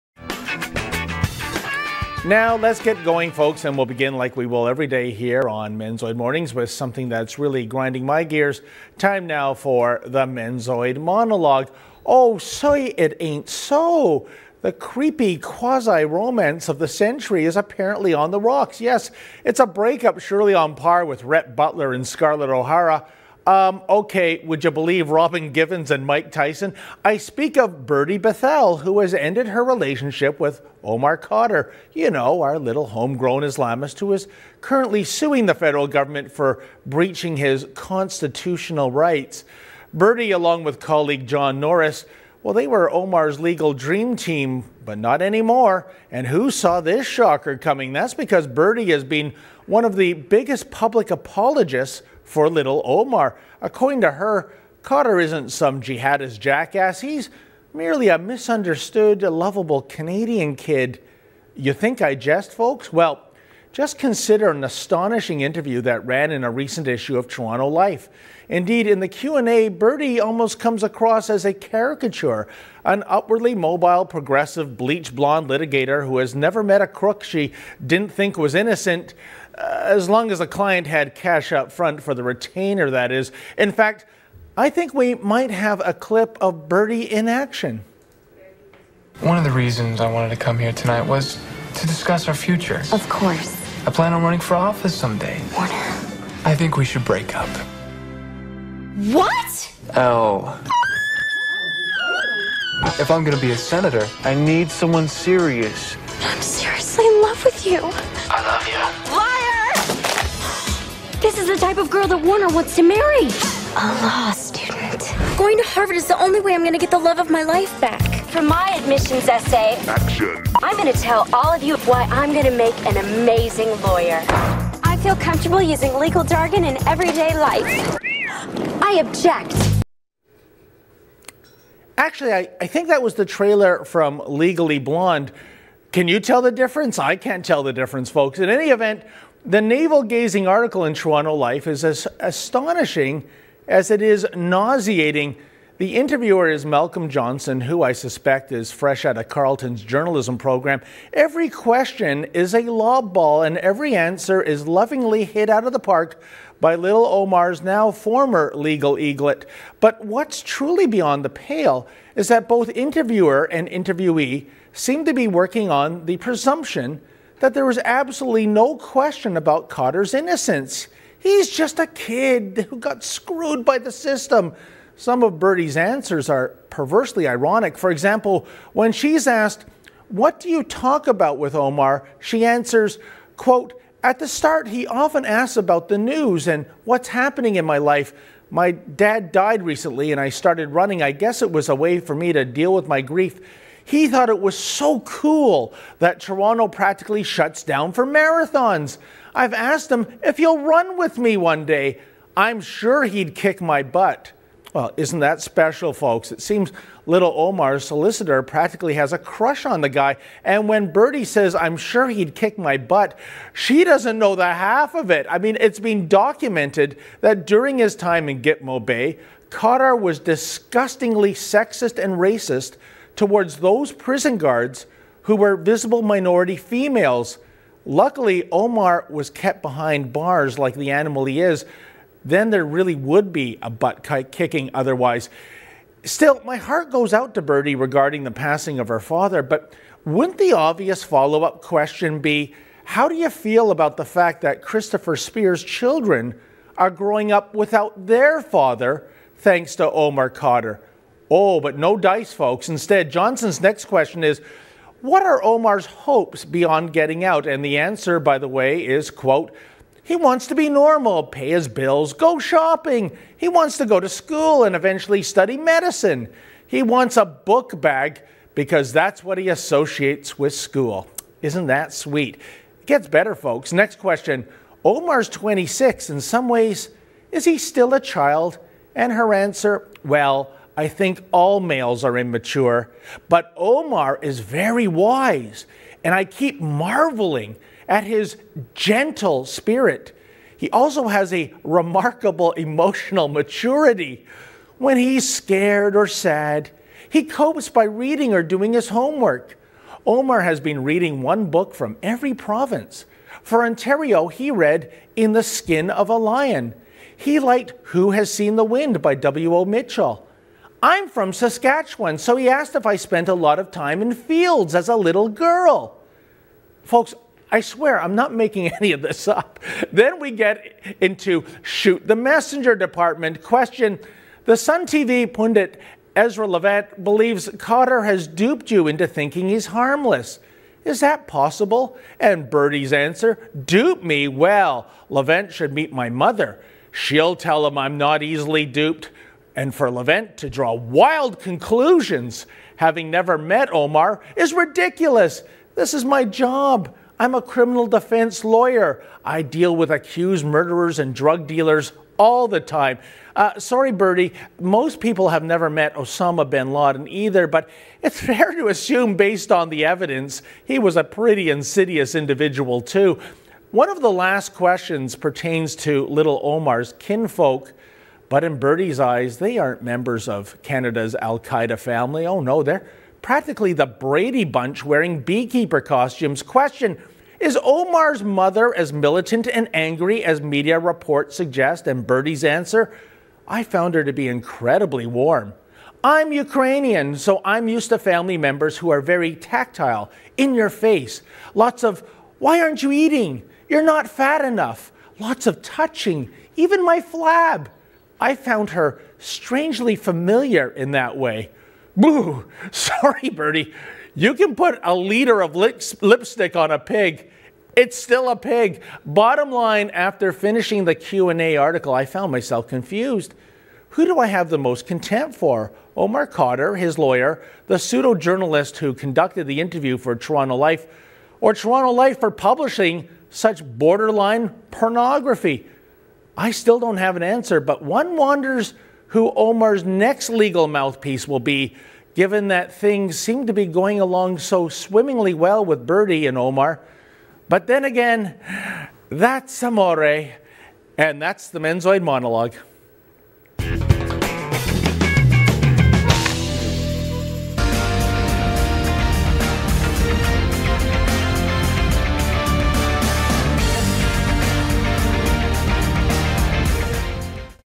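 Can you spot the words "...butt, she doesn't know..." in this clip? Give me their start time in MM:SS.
03:32.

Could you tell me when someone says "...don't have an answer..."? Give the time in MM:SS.
07:06.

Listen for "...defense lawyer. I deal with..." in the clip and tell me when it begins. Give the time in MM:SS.
05:47.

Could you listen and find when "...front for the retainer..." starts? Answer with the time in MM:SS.
01:21.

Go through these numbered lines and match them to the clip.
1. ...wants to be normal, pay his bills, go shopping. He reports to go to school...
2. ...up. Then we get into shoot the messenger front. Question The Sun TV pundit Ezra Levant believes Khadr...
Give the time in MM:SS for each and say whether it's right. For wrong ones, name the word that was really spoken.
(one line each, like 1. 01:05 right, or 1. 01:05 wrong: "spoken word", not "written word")
1. 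04:20 wrong: "wants", not "reports"
2. 05:19 wrong: "department", not "front".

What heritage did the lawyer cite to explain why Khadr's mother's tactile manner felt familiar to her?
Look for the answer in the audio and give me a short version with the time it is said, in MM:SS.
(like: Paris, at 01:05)
Ukrainian, at 06:26.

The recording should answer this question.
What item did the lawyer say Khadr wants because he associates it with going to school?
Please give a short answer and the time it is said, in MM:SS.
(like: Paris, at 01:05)
A book bag, at 04:27.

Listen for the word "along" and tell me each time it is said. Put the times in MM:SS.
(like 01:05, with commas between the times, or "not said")
00:40, 07:13.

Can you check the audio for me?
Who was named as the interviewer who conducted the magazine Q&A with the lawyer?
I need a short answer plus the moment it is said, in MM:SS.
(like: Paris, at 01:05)
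Malcolm Johnson, at 02:26.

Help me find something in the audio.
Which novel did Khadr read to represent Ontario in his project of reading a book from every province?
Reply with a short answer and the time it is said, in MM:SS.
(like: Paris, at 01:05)
In the Skin of a Lion, at 05:05.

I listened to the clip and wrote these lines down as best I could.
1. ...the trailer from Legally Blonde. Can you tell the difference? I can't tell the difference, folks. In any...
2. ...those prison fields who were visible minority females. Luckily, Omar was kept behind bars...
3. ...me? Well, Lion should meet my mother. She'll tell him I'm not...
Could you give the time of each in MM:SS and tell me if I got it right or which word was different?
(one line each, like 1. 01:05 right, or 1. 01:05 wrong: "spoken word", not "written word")
1. 02:13 right
2. 03:43 wrong: "guards", not "fields"
3. 05:34 wrong: "Levant", not "Lion".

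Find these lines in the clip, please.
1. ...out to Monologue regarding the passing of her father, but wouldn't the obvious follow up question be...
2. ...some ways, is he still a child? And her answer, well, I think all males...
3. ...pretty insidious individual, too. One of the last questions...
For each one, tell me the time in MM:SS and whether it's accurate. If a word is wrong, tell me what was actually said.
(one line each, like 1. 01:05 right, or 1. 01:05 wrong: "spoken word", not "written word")
1. 03:57 wrong: "Bertie", not "Monologue"
2. 04:36 right
3. 06:01 right.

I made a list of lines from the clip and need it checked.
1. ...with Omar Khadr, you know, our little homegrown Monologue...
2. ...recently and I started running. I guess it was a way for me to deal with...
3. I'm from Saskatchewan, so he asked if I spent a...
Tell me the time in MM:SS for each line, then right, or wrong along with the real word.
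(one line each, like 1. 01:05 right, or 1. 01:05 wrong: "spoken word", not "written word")
1. 00:30 wrong: "Islamist", not "Monologue"
2. 03:09 right
3. 05:10 right.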